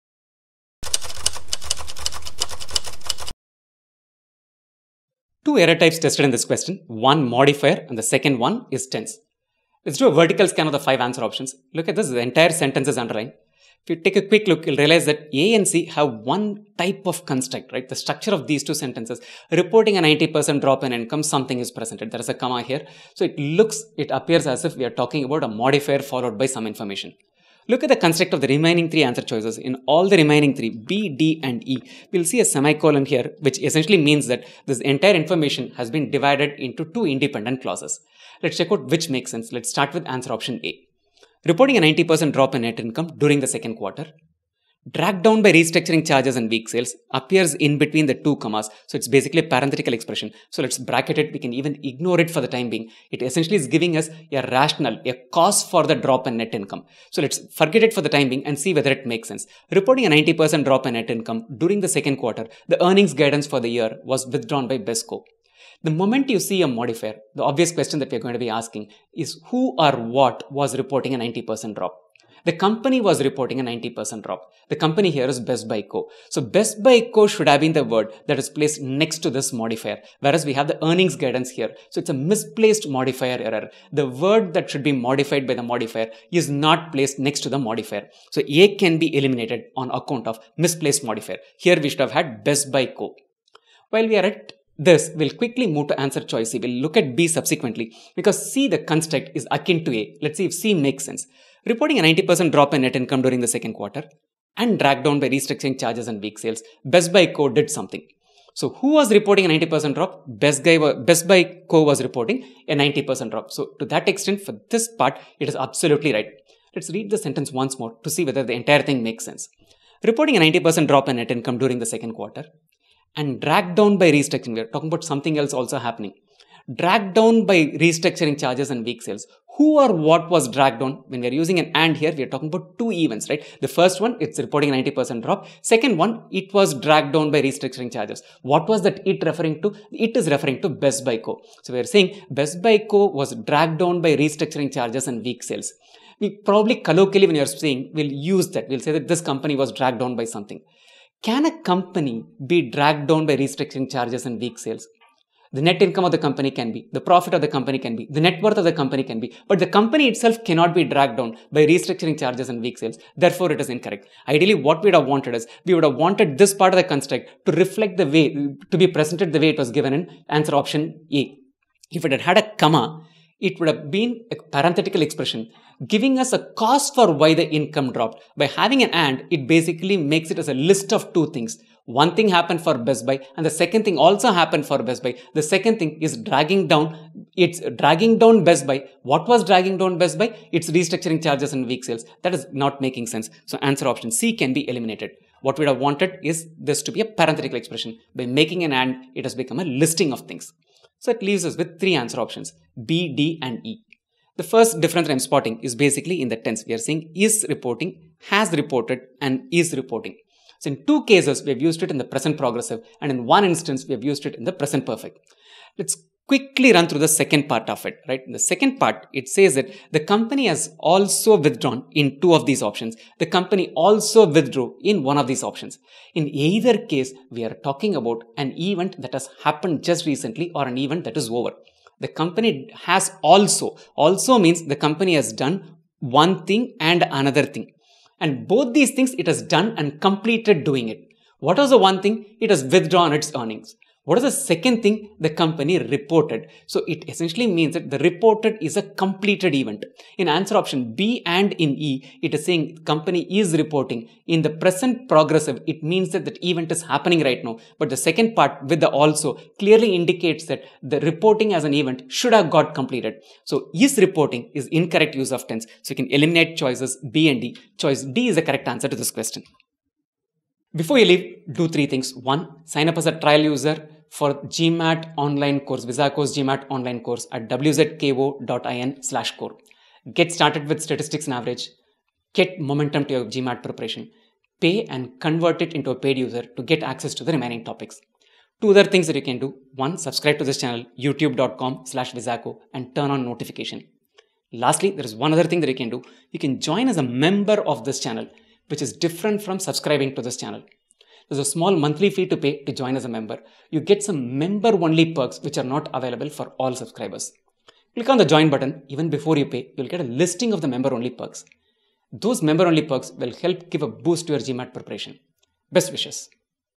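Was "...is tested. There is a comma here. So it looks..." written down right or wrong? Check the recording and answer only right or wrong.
wrong.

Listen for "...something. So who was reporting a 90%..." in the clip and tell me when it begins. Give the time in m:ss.
1:47.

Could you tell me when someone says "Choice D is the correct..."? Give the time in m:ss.
4:27.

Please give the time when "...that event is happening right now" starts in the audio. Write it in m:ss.
4:16.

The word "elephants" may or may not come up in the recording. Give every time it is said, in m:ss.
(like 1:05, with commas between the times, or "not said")
not said.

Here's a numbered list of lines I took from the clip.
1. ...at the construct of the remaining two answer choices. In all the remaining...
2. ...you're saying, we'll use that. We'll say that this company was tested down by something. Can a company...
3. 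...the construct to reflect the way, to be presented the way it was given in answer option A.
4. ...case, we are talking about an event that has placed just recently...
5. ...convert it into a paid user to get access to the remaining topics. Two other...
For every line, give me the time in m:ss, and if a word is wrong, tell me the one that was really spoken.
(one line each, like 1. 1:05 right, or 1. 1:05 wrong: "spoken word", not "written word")
1. 0:27 wrong: "three", not "two"
2. 2:27 wrong: "dragged", not "tested"
3. 2:46 right
4. 3:46 wrong: "happened", not "placed"
5. 4:45 right.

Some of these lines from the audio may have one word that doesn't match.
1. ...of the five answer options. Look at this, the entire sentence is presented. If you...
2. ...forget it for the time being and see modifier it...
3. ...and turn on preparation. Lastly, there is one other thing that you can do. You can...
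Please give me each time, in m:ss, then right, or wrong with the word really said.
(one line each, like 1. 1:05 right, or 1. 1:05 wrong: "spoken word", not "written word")
1. 0:10 wrong: "underlined", not "presented"
2. 0:57 wrong: "whether", not "modifier"
3. 4:52 wrong: "notification", not "preparation".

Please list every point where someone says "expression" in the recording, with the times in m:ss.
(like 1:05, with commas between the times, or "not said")
0:49, 2:55, 3:17.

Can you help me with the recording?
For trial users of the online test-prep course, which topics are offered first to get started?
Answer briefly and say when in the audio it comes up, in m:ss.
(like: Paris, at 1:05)
statistics and average, at 4:40.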